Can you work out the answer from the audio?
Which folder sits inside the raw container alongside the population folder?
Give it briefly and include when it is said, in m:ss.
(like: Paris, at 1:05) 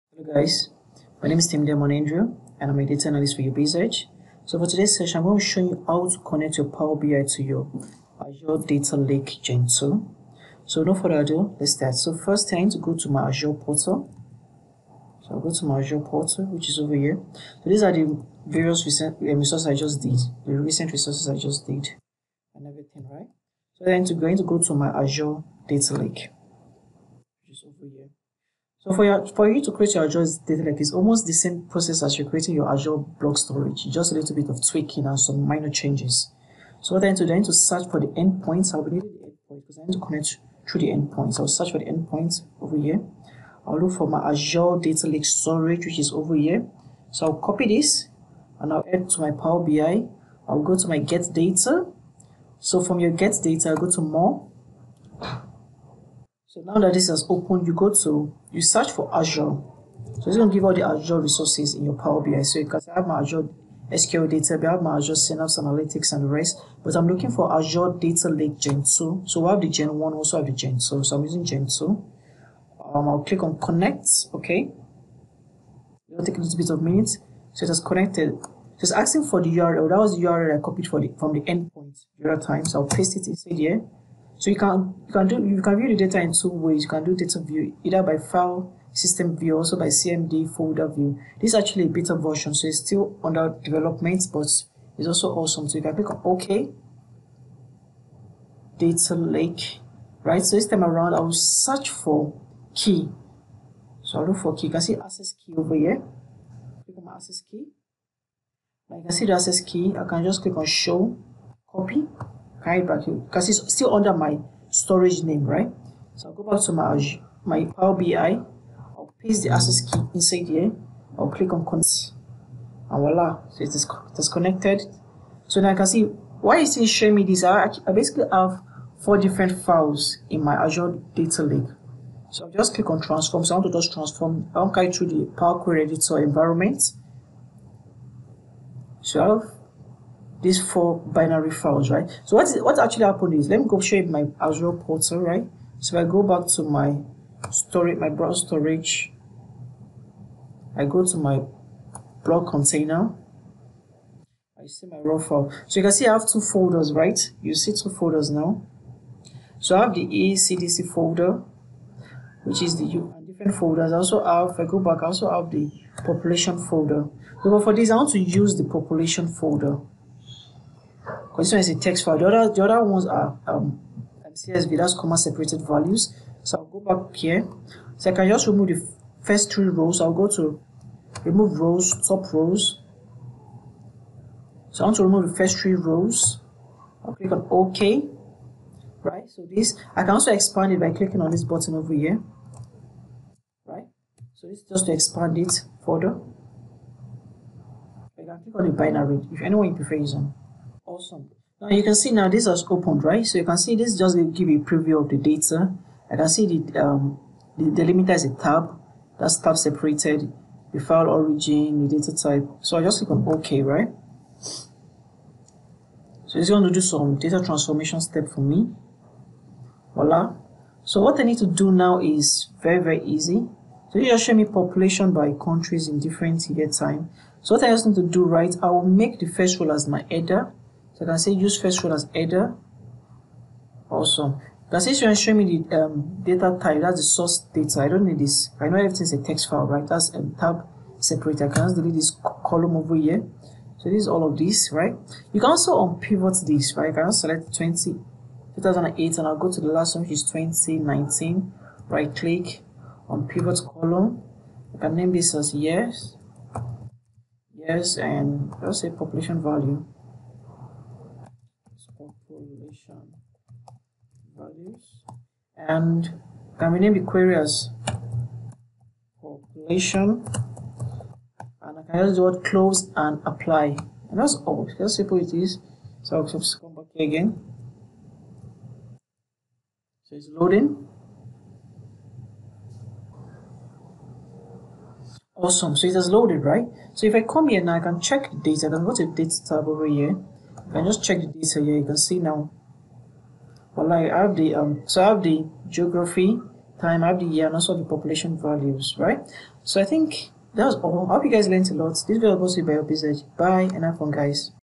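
ECDC, at 2:40.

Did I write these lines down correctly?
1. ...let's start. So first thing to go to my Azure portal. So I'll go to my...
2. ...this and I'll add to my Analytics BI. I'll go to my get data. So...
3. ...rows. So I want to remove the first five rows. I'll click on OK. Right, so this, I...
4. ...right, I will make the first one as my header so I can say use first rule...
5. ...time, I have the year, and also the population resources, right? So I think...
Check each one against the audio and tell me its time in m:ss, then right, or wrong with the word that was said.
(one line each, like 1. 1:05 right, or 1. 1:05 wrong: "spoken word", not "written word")
1. 0:11 right
2. 0:47 wrong: "Power", not "Analytics"
3. 3:02 wrong: "three", not "five"
4. 3:48 right
5. 4:56 wrong: "values", not "resources".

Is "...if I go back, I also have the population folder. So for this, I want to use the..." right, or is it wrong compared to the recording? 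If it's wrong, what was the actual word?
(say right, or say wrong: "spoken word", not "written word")
right.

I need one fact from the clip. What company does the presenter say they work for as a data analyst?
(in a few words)
UrBizEdge.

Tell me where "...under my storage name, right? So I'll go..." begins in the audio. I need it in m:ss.
1:53.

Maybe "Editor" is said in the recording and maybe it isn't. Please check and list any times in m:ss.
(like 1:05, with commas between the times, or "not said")
2:15.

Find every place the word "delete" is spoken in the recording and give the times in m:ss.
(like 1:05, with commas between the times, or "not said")
4:01.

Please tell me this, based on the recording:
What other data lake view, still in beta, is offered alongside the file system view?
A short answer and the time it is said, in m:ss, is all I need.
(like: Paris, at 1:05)
CDM folder view, at 1:29.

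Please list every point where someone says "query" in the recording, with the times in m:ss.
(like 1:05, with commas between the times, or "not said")
2:15, 4:27.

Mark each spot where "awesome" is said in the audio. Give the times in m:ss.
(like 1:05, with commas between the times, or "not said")
1:35, 3:21, 3:53, 4:45.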